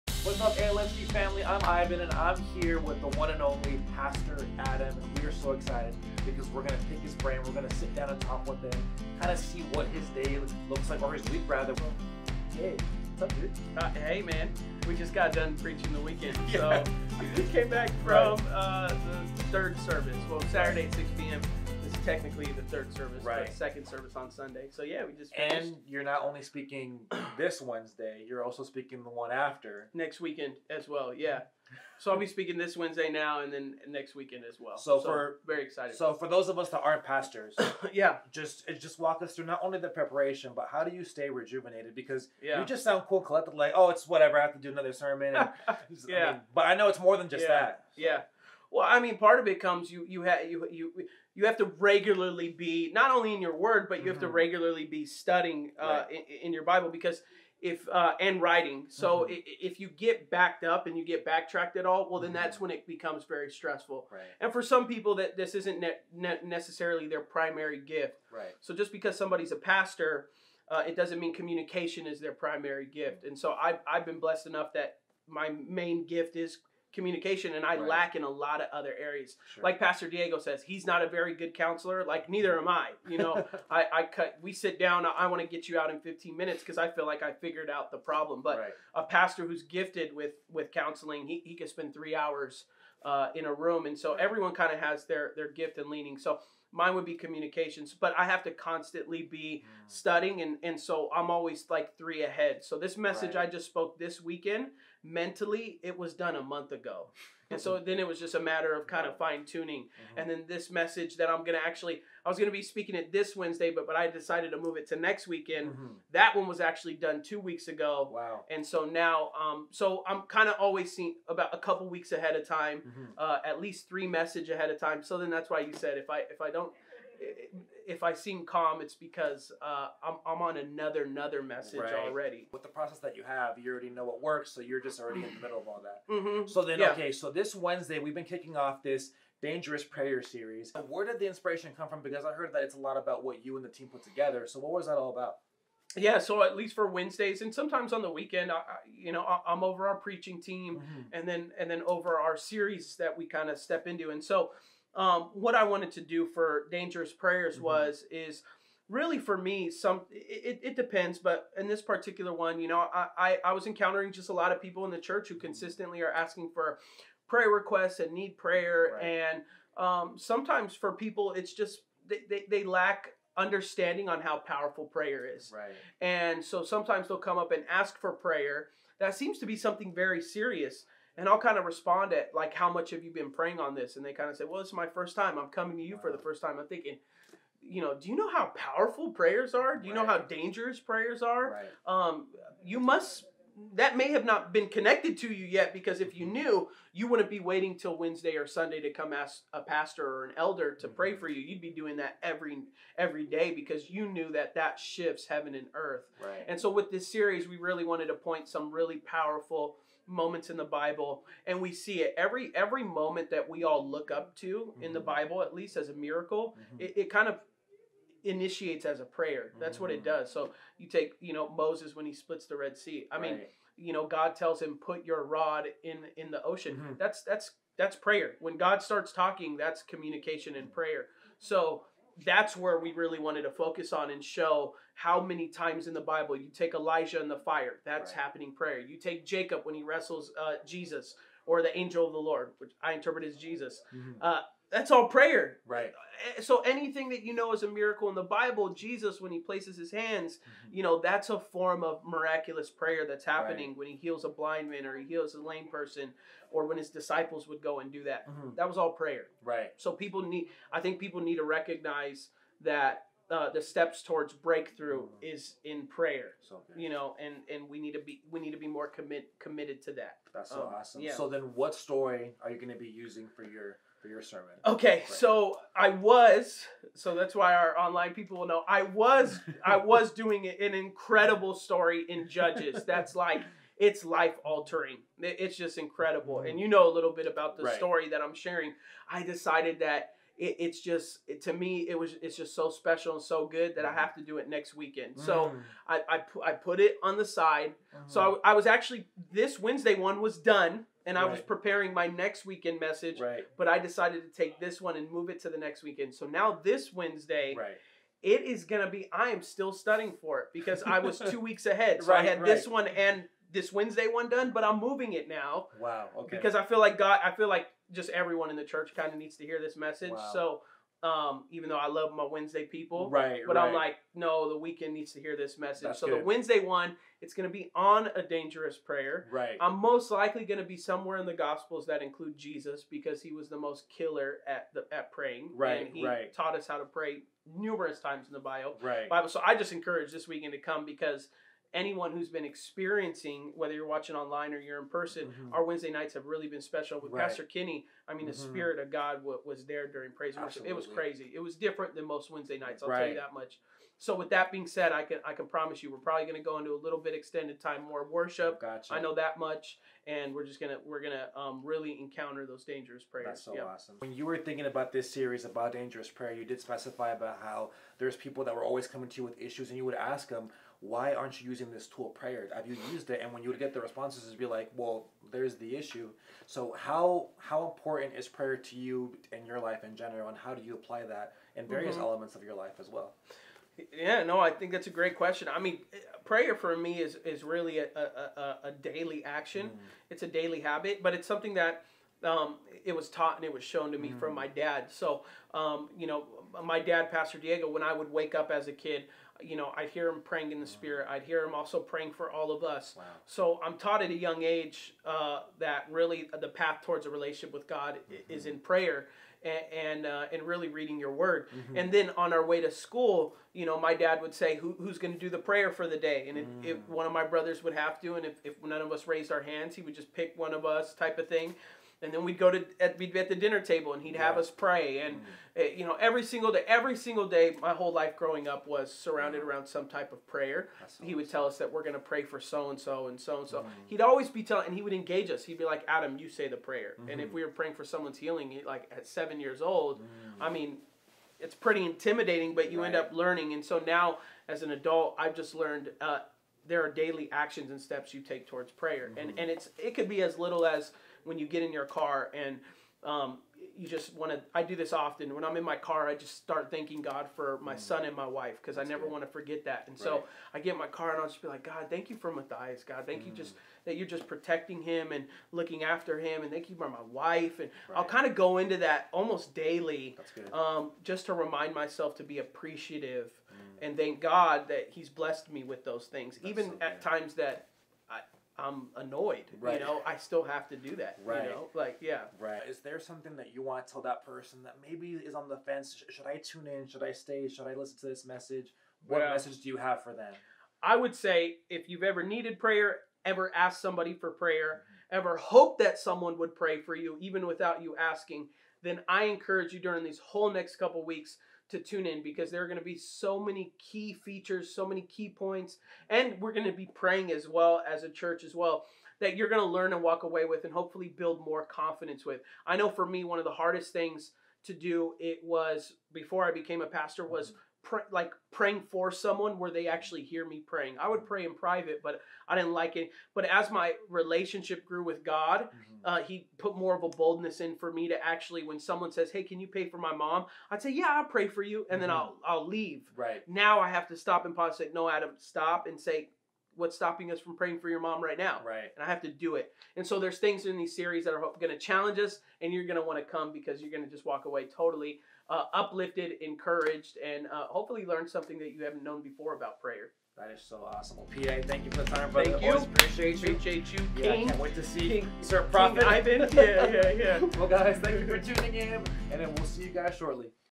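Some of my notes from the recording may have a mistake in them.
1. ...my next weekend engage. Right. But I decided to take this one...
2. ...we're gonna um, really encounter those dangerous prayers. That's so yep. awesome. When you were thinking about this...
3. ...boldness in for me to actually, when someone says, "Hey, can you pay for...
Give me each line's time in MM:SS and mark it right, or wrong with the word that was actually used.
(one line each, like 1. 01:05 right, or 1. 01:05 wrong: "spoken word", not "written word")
1. 05:01 wrong: "message", not "engage"
2. 06:00 right
3. 08:47 right.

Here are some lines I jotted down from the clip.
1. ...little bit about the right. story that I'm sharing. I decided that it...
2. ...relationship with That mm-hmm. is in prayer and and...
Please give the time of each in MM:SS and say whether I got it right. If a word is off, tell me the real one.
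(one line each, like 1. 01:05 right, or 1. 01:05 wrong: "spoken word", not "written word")
1. 04:46 right
2. 06:47 wrong: "God", not "That".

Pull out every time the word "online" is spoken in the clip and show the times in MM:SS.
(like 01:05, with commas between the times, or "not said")
04:37, 05:44.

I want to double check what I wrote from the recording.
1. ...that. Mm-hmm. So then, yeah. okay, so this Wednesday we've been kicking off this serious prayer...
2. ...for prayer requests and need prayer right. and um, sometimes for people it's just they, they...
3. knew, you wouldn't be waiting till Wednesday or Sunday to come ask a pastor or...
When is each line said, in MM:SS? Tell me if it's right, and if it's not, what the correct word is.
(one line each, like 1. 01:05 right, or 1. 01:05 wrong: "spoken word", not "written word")
1. 02:15 wrong: "dangerous", not "serious"
2. 02:46 right
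3. 03:16 right.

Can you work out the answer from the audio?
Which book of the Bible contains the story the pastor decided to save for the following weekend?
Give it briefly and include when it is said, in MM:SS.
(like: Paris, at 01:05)
Judges, at 04:42.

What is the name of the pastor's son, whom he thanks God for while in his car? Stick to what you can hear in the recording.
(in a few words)
Matthias.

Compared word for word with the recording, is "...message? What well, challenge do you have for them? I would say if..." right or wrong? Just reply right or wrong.
wrong.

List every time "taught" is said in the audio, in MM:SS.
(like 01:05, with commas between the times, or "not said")
05:36, 06:33, 06:43.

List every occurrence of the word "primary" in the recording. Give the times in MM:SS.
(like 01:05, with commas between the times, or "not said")
01:07, 01:12.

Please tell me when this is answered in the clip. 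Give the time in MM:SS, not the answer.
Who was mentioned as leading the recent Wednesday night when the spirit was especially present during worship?
05:47.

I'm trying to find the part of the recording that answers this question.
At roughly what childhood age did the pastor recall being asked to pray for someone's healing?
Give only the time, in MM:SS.
07:19.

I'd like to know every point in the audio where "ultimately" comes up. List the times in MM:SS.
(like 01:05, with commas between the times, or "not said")
not said.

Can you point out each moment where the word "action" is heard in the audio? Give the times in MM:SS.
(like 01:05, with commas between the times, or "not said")
06:29, 07:27.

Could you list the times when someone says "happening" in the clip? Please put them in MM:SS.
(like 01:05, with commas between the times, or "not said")
03:58, 04:13.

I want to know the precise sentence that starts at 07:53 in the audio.
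and thank God that He's blessed me with those things, That's even so at times that I'm annoyed.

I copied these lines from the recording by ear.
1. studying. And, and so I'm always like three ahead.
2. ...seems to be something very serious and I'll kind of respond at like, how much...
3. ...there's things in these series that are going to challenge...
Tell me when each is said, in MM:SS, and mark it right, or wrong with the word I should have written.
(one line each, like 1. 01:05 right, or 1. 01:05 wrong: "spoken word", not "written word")
1. 01:39 right
2. 02:59 right
3. 09:00 right.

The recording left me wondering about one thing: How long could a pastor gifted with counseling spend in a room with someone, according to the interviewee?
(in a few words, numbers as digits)
Three hours.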